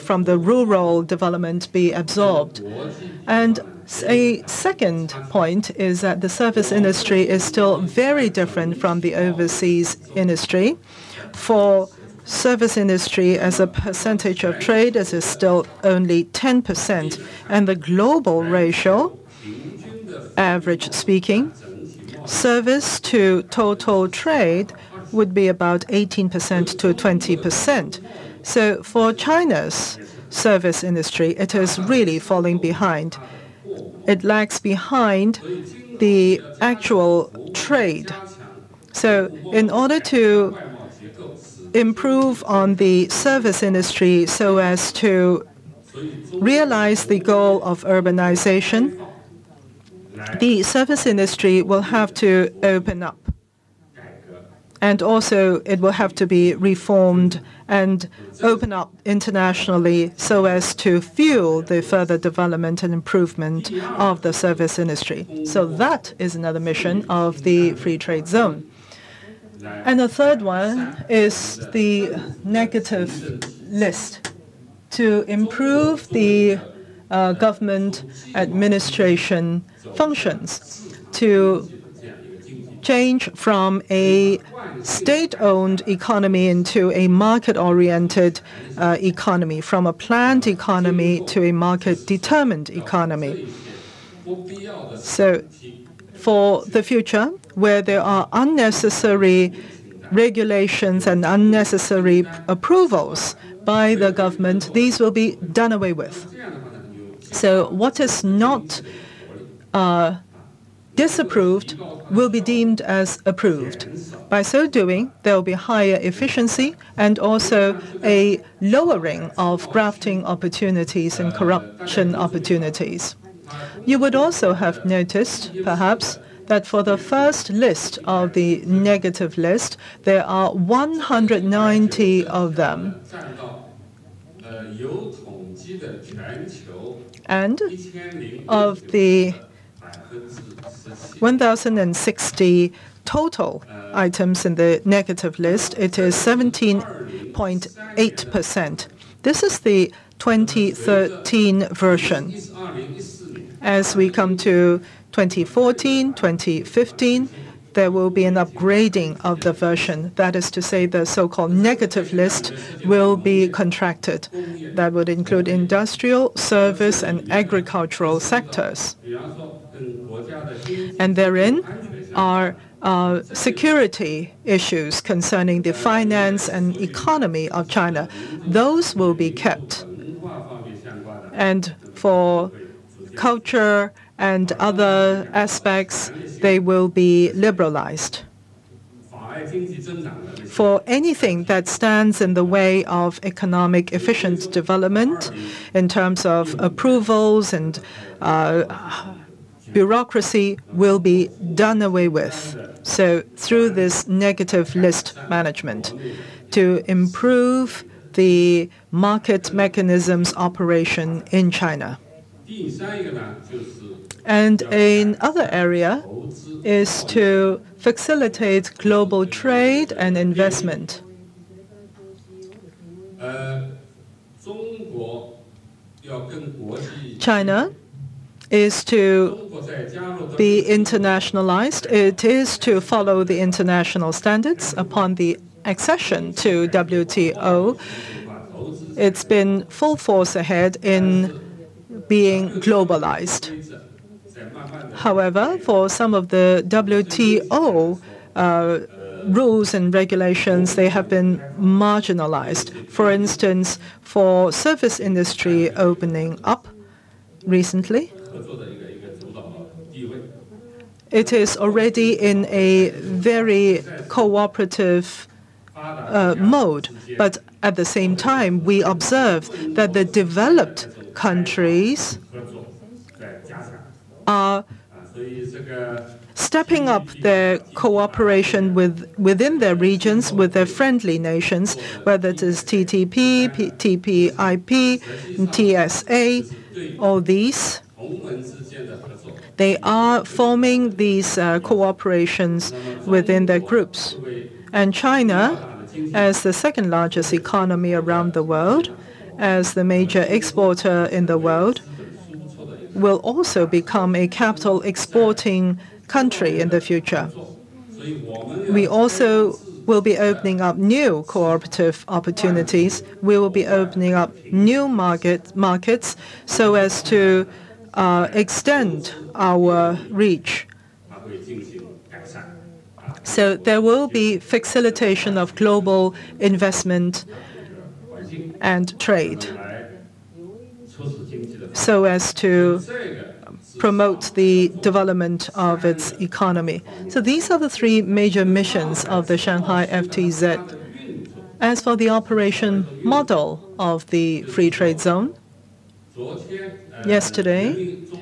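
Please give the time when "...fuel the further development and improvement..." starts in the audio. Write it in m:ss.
1:01.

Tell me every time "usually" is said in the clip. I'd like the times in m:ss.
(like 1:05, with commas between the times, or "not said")
not said.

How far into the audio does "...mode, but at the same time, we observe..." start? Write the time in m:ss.
4:26.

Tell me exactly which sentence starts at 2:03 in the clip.
You would also have noticed, perhaps, that for the first list of the negative list, there are 190 of them.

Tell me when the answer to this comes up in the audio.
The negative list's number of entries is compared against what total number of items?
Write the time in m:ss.
2:21.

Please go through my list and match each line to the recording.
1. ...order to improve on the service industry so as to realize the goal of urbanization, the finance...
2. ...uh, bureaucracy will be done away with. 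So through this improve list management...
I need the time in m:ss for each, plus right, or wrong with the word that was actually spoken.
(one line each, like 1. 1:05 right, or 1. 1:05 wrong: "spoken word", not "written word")
1. 0:39 wrong: "service", not "finance"
2. 3:18 wrong: "negative", not "improve".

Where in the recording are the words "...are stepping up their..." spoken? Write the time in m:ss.
4:34.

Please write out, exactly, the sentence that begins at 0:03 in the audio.
And a second point is that the service industry is still very different from the overseas industry.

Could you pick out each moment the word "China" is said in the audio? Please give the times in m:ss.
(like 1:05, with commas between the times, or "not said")
0:29, 2:57, 3:31, 3:47, 4:54.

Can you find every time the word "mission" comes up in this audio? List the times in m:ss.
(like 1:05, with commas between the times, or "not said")
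1:06, 5:38.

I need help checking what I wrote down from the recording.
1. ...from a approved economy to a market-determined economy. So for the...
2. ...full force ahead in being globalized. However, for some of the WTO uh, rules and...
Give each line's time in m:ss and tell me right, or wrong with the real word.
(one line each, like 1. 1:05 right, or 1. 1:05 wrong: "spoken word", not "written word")
1. 1:29 wrong: "planned", not "approved"
2. 3:59 right.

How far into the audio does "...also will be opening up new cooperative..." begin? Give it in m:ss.
5:08.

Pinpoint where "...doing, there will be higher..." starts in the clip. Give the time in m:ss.
1:54.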